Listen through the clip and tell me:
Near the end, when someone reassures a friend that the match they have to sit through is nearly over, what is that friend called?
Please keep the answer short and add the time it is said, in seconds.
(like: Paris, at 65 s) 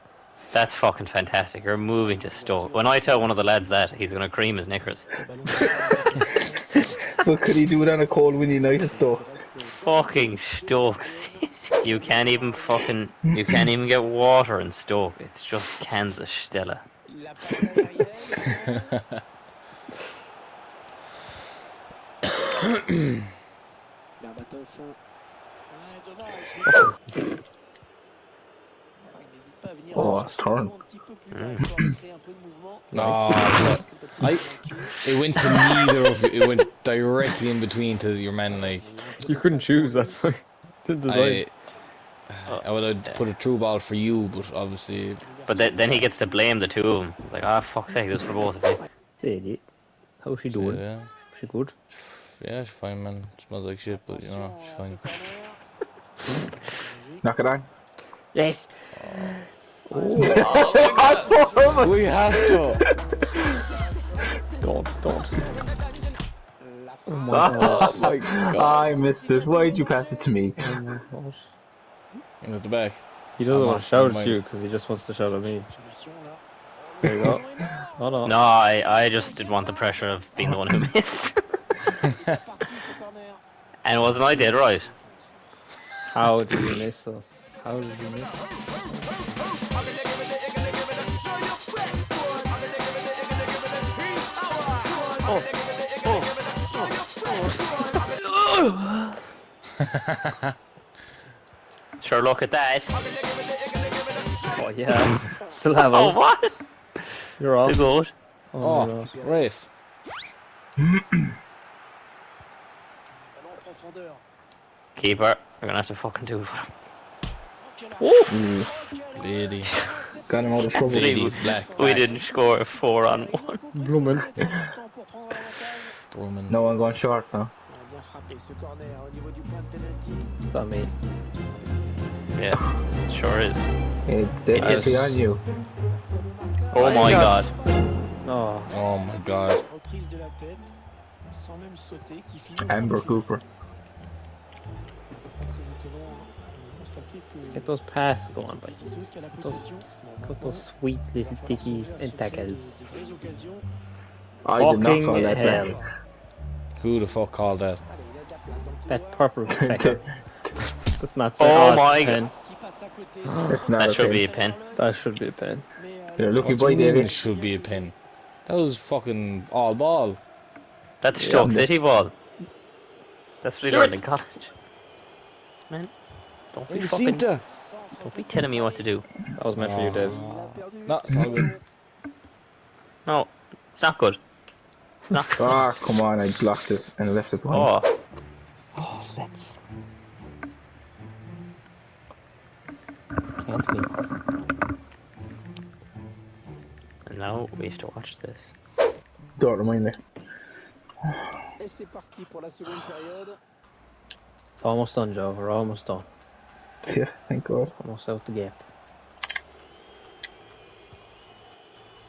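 Joe, at 205 s.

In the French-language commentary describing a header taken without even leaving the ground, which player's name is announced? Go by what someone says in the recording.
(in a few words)
Amber Cooper.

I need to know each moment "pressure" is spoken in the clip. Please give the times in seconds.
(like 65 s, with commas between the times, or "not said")
79 s.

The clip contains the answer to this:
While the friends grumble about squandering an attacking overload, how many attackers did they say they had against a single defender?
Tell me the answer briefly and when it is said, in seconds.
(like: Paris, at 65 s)
4, at 122 s.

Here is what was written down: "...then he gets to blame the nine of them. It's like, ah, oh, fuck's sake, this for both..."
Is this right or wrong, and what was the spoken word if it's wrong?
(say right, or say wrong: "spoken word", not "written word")
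wrong: "two", not "nine".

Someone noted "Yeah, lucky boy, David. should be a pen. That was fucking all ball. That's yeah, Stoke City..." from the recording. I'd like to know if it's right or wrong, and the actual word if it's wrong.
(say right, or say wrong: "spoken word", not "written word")
right.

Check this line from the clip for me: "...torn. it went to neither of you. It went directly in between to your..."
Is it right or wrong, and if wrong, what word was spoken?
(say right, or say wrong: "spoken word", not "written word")
right.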